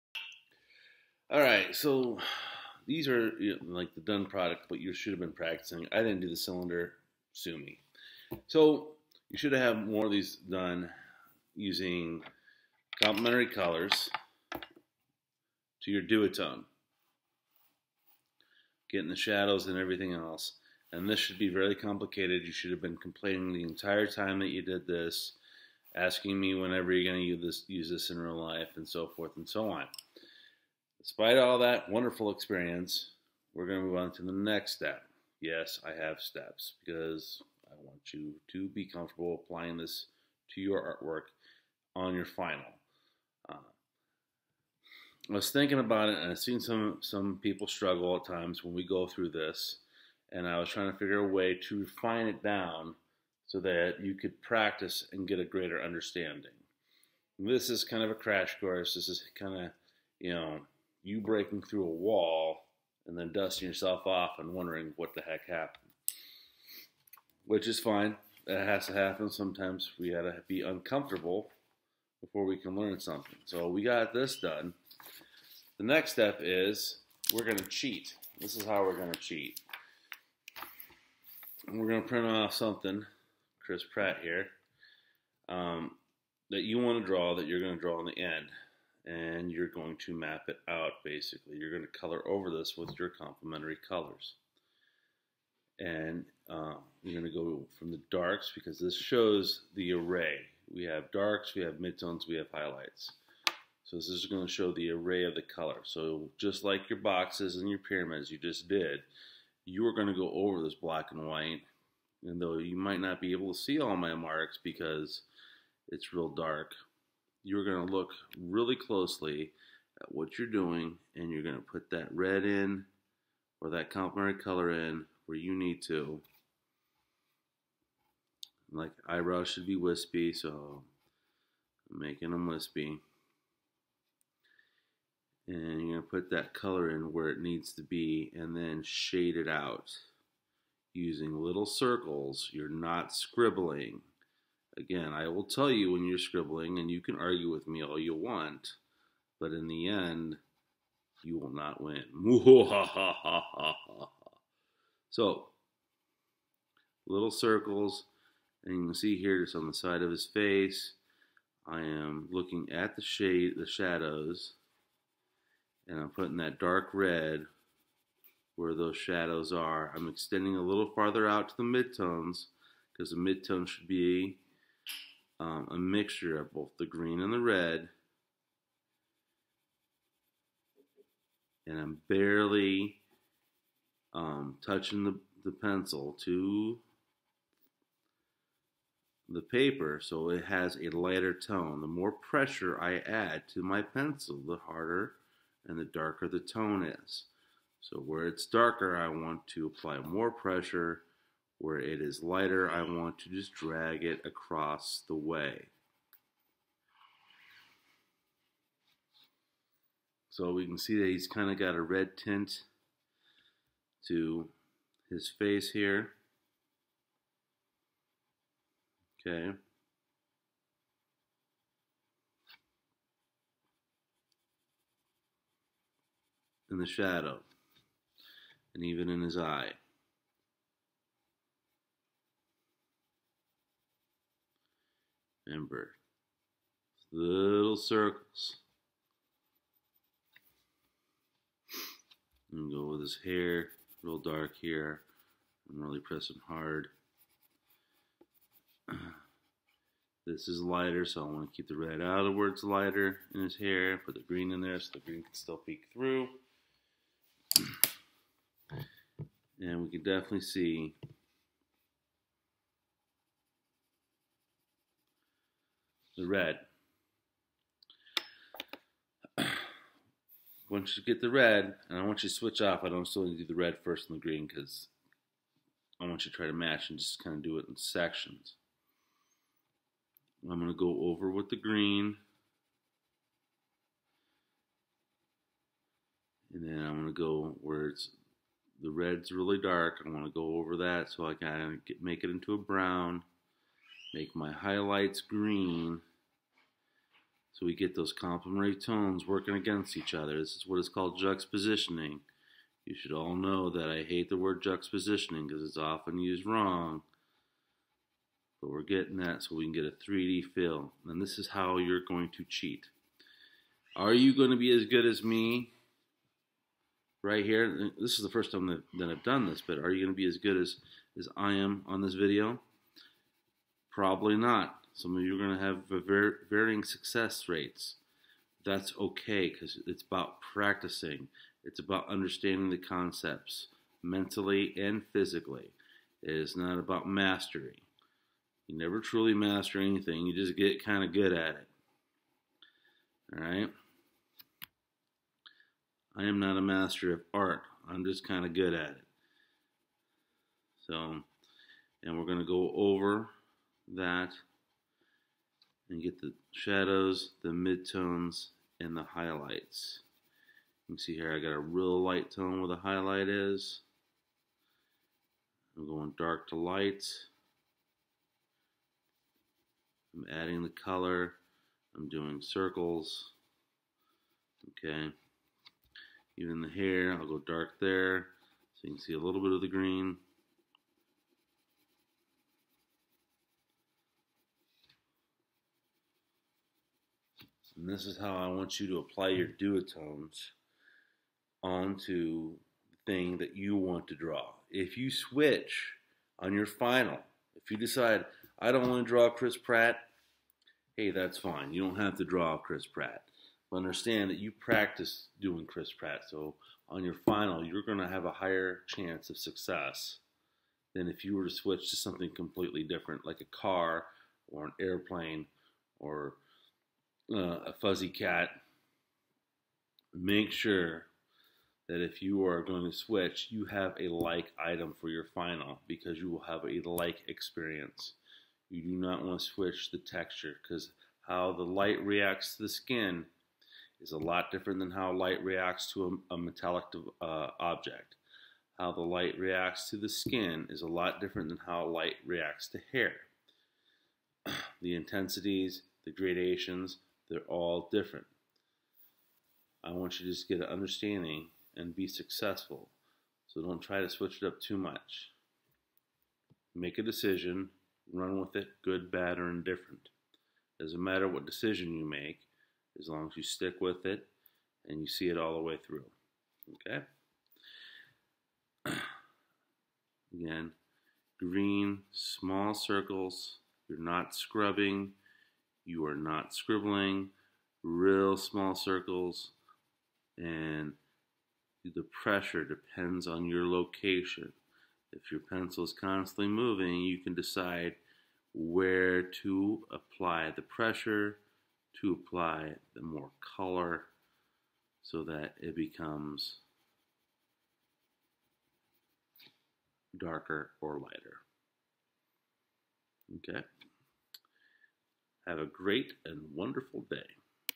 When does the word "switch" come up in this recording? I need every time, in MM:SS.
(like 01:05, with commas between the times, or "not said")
04:32, 06:35, 06:51, 07:02, 07:09, 07:34.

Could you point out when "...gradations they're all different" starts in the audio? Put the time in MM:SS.
07:26.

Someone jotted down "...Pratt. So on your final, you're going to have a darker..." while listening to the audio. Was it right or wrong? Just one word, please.
wrong.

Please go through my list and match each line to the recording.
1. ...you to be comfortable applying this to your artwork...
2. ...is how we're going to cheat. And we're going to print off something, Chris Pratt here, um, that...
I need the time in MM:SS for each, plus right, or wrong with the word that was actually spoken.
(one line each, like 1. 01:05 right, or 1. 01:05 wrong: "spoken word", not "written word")
1. 00:38 right
2. 01:18 right.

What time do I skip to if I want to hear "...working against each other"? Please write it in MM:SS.
04:59.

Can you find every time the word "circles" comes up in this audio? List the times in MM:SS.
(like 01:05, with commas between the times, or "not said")
02:21, 02:37, 03:57, 06:12, 07:52, 07:58.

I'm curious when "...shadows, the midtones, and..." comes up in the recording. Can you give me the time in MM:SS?
05:56.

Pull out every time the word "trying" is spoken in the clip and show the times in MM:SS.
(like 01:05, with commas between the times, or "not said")
00:50.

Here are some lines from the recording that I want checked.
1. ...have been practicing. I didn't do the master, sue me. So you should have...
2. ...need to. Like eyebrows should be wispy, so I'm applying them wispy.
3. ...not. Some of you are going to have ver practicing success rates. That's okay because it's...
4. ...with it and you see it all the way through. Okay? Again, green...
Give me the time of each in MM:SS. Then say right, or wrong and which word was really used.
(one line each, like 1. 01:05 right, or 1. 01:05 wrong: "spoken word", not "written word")
1. 00:05 wrong: "cylinder", not "master"
2. 02:05 wrong: "making", not "applying"
3. 05:24 wrong: "varying", not "practicing"
4. 07:43 right.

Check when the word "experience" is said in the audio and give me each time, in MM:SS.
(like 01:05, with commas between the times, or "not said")
00:32, 07:07.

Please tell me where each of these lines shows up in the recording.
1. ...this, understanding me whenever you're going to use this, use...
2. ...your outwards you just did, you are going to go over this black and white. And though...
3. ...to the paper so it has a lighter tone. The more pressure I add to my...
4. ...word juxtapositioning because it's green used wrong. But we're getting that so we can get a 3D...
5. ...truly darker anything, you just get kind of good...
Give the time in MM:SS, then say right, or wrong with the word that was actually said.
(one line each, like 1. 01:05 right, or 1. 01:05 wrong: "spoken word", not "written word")
1. 00:24 wrong: "asking", not "understanding"
2. 01:47 wrong: "pyramids", not "outwards"
3. 03:06 right
4. 05:04 wrong: "often", not "green"
5. 05:39 wrong: "master", not "darker".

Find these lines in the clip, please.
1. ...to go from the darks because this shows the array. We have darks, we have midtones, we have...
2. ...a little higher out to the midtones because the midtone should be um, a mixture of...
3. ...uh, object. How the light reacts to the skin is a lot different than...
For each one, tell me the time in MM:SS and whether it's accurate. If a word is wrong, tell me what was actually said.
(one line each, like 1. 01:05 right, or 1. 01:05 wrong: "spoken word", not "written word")
1. 01:37 right
2. 02:50 wrong: "farther", not "higher"
3. 07:17 right.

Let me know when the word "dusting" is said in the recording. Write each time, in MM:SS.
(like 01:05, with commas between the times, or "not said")
01:03.